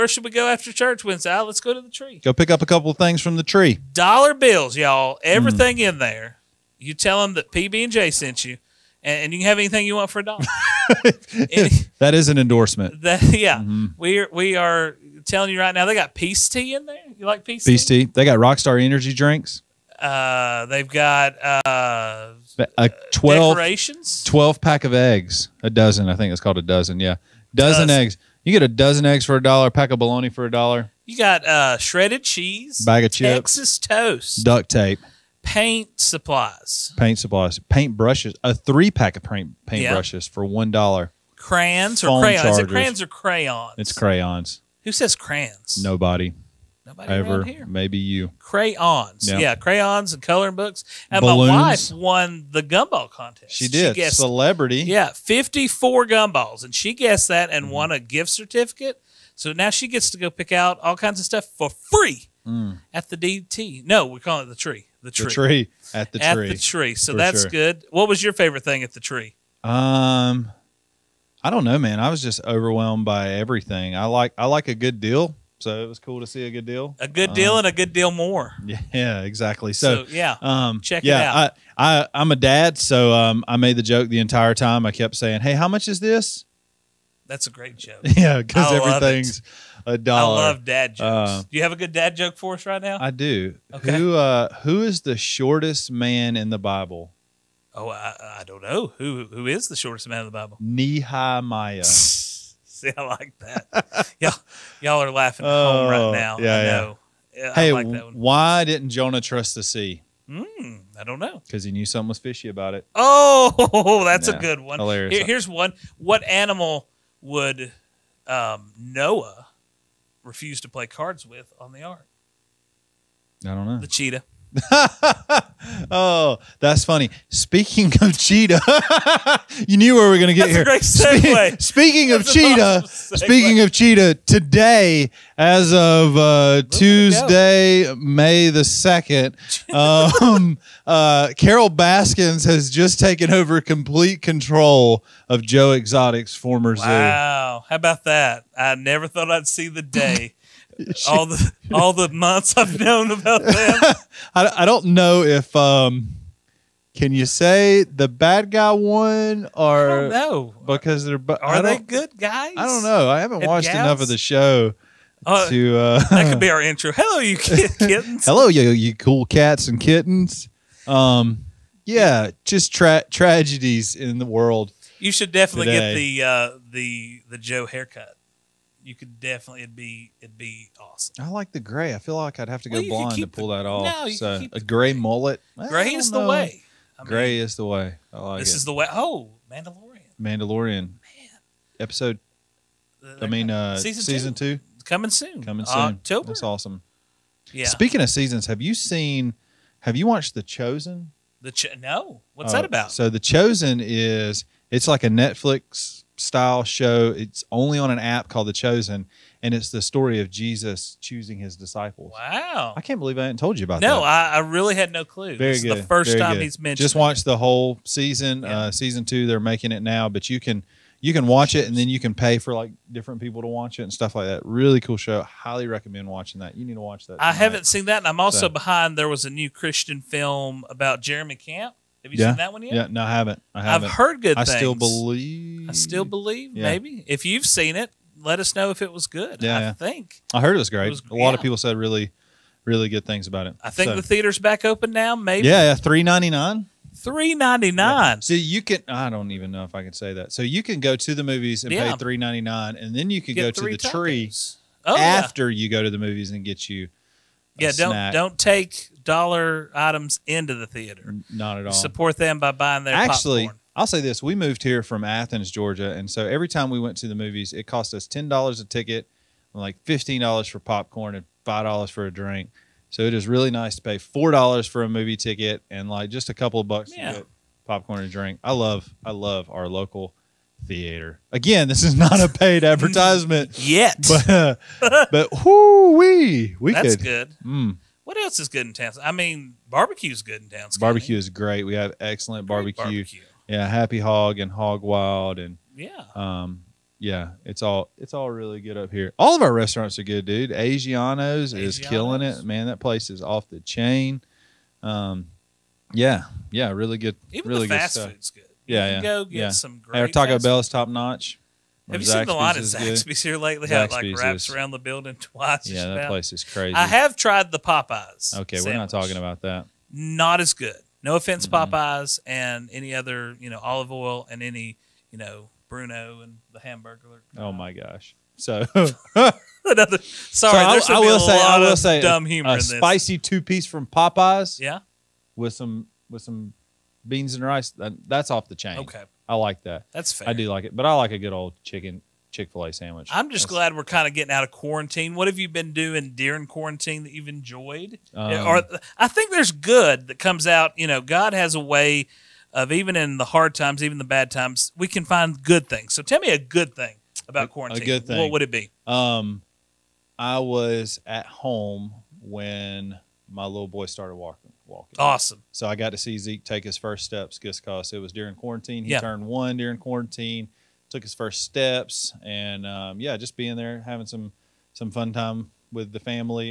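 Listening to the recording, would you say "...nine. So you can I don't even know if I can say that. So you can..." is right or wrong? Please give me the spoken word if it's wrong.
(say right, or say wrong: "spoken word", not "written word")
right.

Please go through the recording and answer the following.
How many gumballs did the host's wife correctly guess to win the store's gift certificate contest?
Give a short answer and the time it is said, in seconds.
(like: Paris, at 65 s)
54, at 55 s.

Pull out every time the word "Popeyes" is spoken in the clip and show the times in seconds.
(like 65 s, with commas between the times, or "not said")
317 s, 321 s, 333 s.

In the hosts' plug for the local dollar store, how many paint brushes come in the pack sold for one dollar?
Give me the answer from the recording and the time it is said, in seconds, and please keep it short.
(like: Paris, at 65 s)
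3, at 38 s.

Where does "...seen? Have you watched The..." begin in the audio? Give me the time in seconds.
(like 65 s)
198 s.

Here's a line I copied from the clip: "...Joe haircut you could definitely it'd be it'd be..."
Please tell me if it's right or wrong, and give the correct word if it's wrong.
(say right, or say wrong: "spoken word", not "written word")
right.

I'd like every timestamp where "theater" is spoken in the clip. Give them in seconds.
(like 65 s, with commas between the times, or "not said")
244 s, 260 s, 280 s.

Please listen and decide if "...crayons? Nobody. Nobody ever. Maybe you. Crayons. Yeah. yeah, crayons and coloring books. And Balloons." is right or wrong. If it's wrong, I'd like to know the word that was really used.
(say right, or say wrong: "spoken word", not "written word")
right.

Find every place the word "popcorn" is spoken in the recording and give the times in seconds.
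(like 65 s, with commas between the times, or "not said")
263 s, 270 s, 277 s.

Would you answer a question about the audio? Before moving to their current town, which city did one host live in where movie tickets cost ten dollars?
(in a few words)
Athens, Georgia.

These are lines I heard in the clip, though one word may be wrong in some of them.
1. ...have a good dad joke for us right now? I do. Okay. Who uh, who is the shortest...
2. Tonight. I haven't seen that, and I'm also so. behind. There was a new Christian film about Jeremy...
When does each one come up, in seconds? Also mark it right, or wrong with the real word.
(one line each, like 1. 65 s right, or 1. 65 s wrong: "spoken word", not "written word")
1. 91 s right
2. 227 s right.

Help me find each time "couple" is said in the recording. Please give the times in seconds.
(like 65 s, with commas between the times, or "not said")
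2 s, 276 s.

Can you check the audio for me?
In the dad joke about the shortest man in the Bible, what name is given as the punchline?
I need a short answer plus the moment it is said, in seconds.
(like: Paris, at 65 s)
Nehemiah, at 100 s.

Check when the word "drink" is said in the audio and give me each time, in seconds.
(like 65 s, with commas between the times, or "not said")
19 s, 272 s, 278 s.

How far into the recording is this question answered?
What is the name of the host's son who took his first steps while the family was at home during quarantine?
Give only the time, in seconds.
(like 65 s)
366 s.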